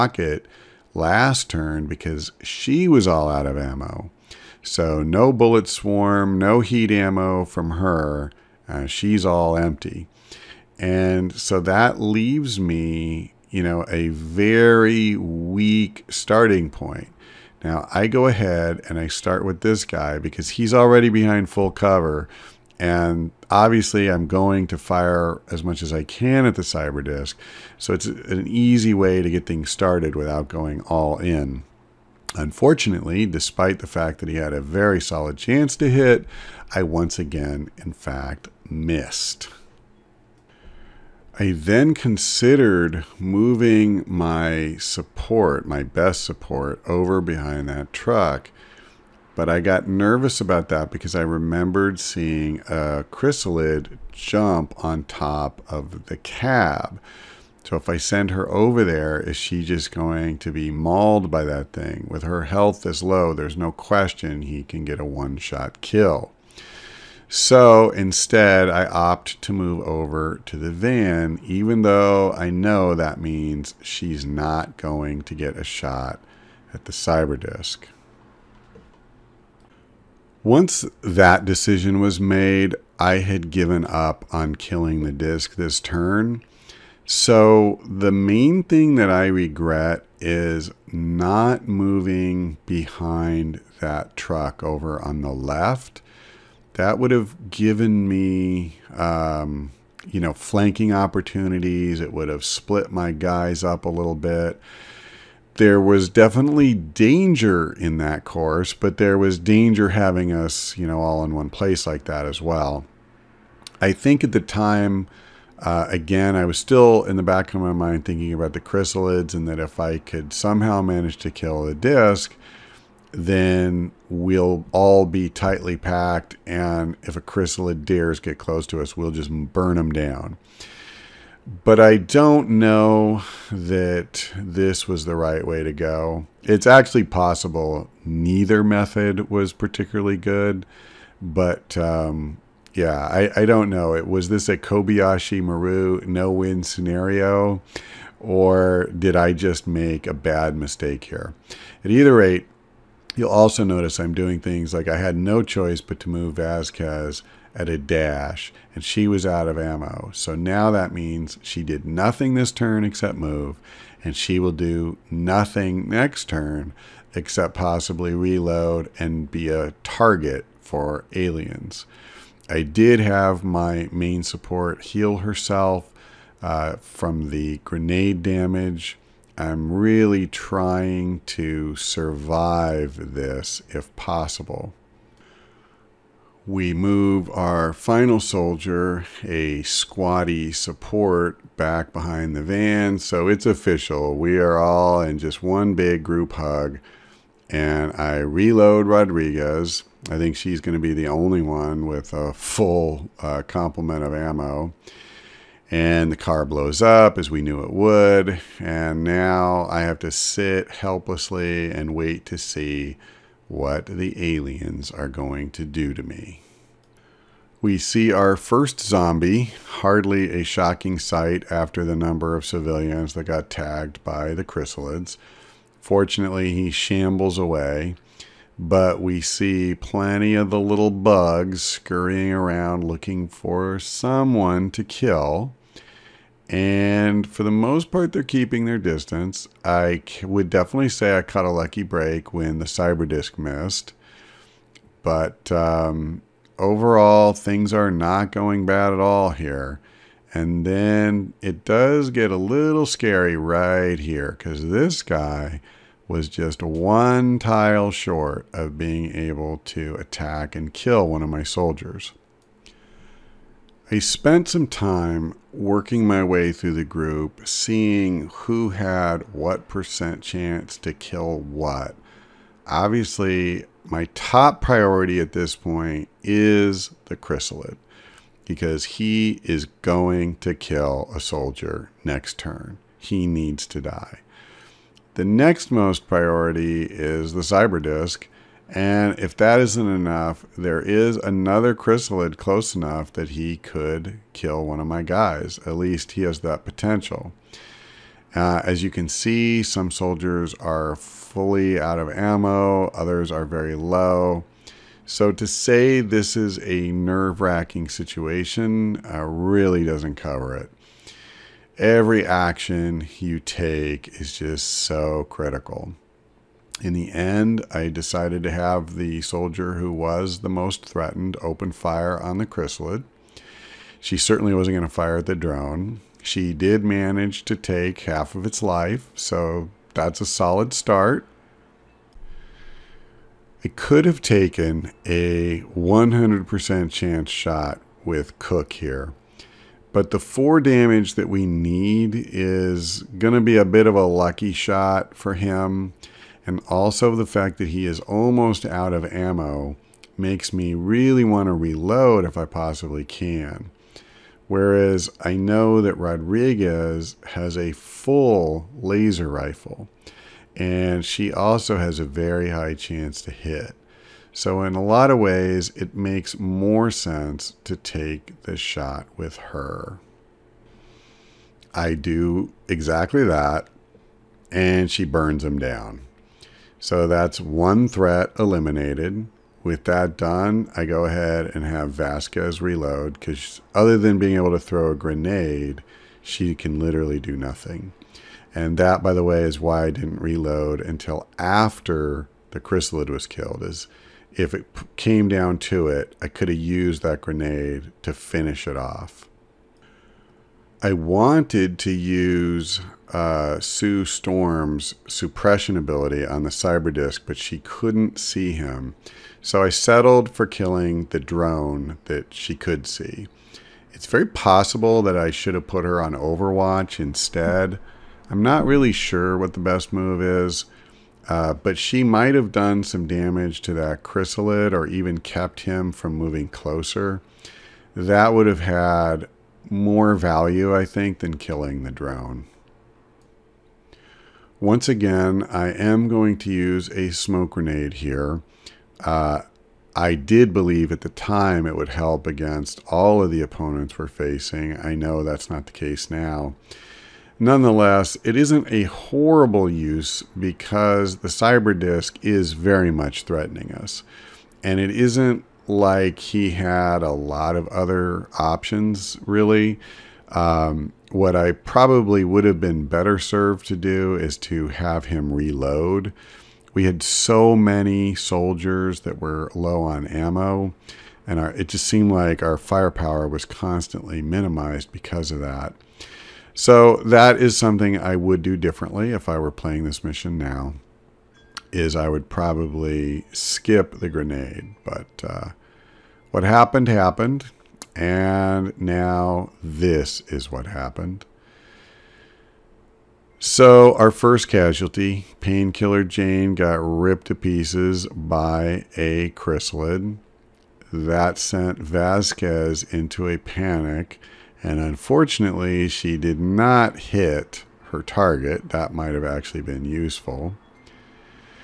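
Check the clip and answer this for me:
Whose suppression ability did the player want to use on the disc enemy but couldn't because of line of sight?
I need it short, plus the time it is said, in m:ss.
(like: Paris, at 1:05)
Sue Storm, at 6:43.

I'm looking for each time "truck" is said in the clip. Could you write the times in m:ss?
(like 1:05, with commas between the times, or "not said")
0:47, 1:34.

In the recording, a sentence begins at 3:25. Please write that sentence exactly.
And the car blows up as we knew it would.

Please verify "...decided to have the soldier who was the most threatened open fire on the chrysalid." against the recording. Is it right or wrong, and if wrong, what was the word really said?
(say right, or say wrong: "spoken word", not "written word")
right.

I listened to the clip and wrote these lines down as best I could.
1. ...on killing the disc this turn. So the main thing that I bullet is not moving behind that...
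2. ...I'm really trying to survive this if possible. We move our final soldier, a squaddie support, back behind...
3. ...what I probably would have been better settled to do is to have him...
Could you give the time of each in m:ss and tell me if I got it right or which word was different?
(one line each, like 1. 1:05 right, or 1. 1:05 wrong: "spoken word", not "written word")
1. 1:24 wrong: "regret", not "bullet"
2. 2:59 right
3. 7:41 wrong: "served", not "settled".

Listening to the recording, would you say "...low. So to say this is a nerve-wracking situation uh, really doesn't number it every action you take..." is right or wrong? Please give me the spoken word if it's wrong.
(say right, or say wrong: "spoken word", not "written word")
wrong: "cover", not "number".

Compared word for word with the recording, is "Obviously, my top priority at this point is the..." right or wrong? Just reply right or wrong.
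right.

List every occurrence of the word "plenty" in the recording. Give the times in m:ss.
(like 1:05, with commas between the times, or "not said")
3:49.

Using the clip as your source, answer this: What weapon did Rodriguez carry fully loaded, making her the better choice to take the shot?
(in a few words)
Laser rifle.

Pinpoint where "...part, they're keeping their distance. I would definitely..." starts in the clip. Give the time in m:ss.
3:57.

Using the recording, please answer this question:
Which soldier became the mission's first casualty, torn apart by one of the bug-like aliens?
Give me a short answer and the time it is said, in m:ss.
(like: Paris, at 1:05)
Painkiller Jane, at 8:15.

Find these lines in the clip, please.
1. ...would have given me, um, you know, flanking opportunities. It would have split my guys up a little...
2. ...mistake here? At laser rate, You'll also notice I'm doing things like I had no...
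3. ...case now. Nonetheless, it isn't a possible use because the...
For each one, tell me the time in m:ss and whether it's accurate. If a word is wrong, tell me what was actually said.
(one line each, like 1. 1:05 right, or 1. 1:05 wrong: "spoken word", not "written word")
1. 1:36 right
2. 2:30 wrong: "either", not "laser"
3. 7:25 wrong: "horrible", not "possible".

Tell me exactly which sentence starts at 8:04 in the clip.
But uh, what happened happened, and now this is what happened.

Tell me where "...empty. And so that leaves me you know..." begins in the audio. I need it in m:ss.
0:09.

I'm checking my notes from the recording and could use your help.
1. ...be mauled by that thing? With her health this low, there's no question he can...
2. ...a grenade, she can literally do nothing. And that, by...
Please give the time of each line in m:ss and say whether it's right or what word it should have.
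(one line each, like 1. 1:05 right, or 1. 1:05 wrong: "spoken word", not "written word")
1. 1:00 right
2. 6:24 right.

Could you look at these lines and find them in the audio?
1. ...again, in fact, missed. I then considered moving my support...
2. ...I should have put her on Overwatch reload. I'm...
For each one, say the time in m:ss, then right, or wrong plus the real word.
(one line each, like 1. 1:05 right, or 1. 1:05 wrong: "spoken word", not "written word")
1. 0:37 right
2. 6:55 wrong: "instead", not "reload".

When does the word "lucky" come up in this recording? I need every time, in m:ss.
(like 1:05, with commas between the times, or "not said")
4:01, 5:44.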